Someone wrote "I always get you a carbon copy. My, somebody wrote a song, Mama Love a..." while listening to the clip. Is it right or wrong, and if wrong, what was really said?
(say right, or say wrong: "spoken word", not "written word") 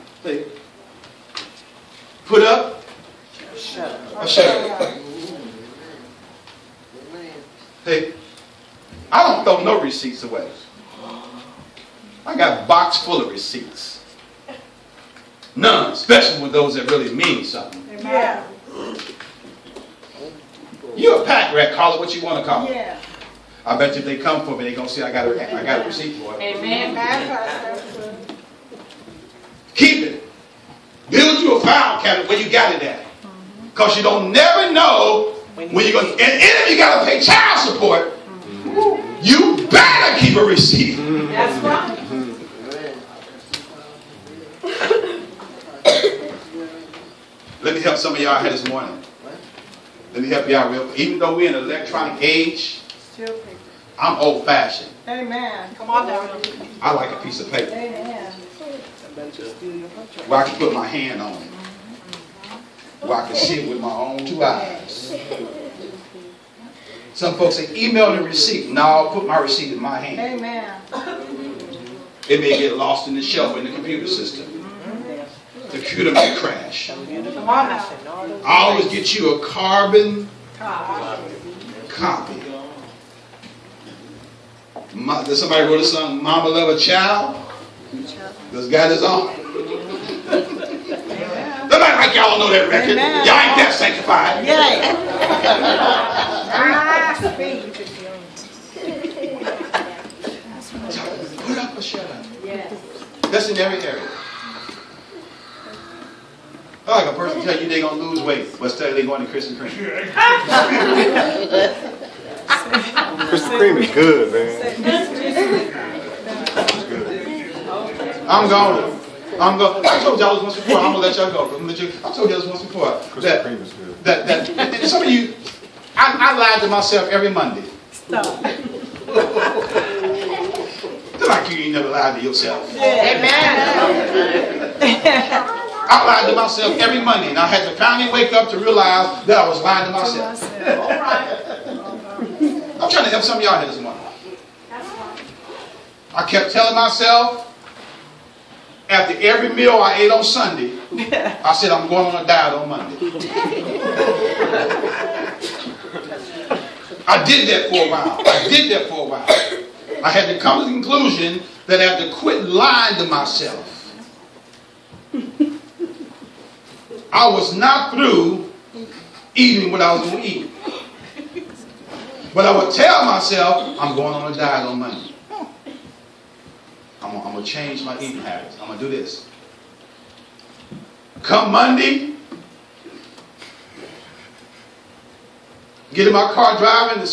right.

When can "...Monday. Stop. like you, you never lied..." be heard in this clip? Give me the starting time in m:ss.
2:07.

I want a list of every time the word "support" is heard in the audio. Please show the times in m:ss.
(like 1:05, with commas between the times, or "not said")
0:37.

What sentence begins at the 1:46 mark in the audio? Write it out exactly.
I a person tell you they're going to lose weight, but still they going to Krispy Kreme.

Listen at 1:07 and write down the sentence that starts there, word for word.
Some folks say, email the receipt.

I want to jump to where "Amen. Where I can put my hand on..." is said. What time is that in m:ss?
0:57.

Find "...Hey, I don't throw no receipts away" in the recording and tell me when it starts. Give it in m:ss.
0:07.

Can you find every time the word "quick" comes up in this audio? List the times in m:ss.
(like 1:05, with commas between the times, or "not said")
0:50.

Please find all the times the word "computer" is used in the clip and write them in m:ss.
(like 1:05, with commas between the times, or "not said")
1:13.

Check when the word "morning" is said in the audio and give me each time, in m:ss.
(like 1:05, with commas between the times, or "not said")
0:48, 2:23.